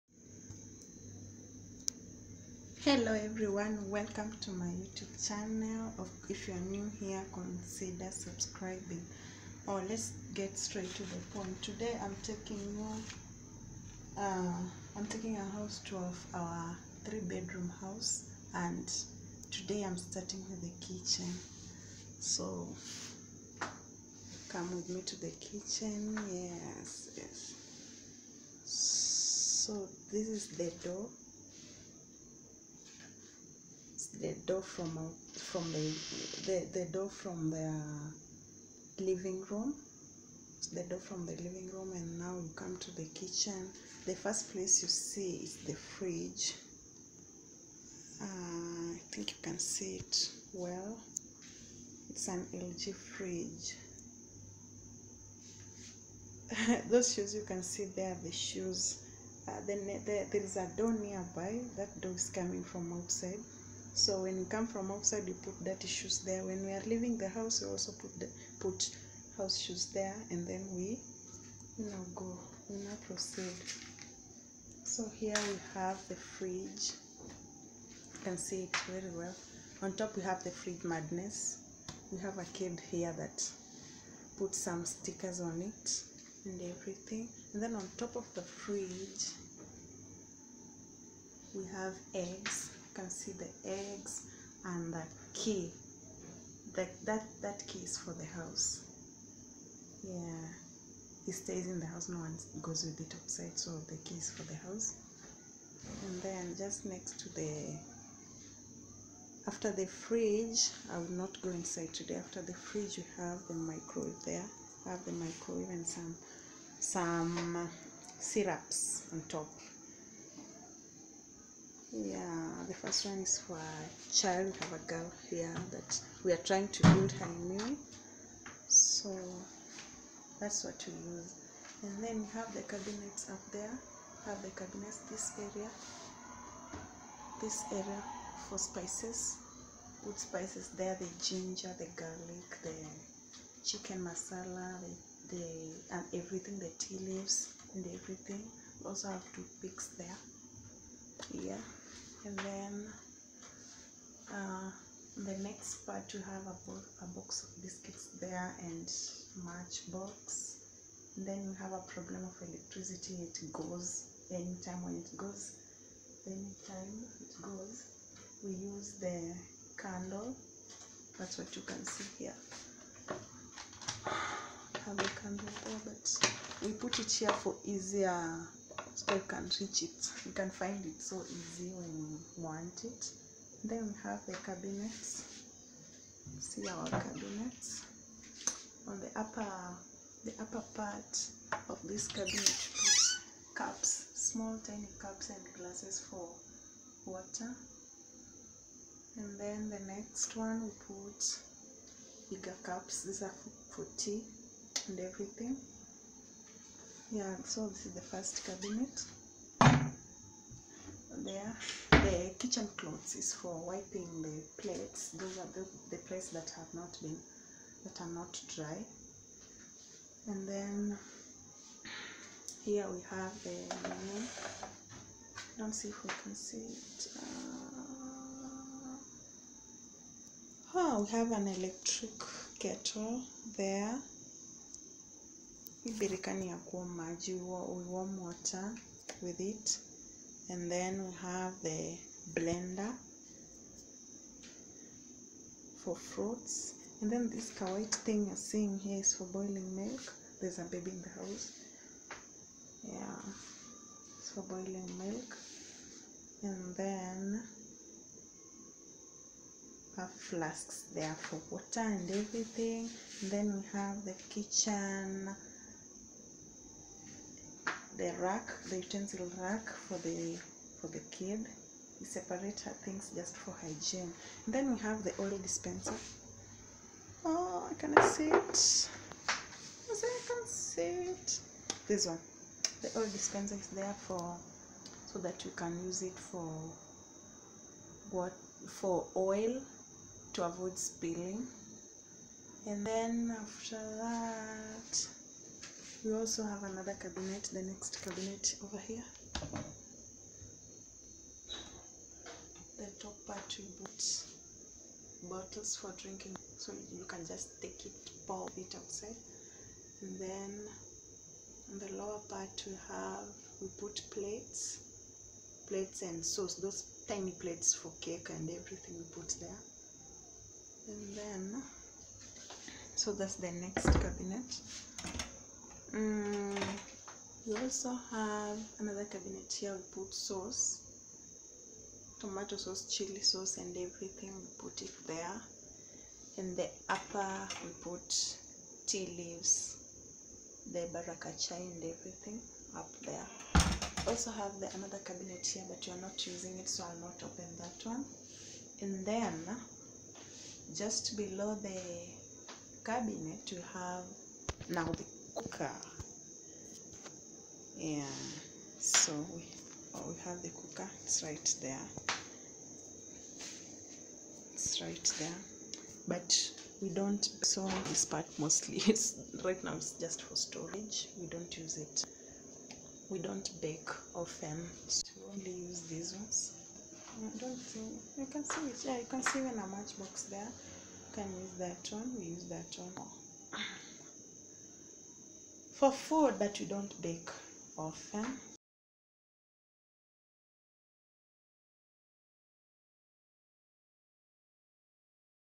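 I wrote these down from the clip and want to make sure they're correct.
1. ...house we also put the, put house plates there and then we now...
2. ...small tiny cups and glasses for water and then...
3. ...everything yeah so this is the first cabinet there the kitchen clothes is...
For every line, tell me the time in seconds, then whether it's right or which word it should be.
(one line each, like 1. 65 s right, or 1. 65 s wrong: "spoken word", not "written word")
1. 67 s wrong: "shoes", not "plates"
2. 194 s right
3. 204 s right.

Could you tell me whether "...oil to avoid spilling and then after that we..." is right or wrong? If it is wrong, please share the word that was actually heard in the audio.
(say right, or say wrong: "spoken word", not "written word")
right.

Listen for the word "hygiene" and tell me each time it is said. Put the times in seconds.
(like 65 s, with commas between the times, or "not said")
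273 s.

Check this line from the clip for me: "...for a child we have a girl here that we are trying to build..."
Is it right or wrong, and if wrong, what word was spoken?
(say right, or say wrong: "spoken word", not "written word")
right.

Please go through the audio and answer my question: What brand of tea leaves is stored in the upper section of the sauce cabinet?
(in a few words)
Baraka Chai.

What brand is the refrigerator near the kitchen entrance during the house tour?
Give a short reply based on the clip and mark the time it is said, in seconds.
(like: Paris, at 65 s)
LG, at 52 s.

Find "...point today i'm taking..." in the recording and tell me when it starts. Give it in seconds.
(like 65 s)
11 s.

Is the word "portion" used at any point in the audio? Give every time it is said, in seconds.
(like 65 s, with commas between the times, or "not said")
not said.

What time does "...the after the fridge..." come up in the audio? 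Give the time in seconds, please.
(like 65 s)
107 s.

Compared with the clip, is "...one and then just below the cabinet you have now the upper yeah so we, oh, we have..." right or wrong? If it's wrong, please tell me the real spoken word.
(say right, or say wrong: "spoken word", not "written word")
wrong: "cooker", not "upper".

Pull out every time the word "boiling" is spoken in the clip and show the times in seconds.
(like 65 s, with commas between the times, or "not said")
249 s, 254 s.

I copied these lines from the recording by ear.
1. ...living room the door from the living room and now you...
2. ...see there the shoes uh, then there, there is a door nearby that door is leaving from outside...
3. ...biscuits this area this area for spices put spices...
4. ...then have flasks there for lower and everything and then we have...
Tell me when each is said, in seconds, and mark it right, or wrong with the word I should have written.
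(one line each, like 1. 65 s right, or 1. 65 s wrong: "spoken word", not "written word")
1. 38 s right
2. 57 s wrong: "coming", not "leaving"
3. 134 s wrong: "cabinets", not "biscuits"
4. 256 s wrong: "water", not "lower".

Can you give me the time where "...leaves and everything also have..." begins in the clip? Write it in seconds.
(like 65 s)
146 s.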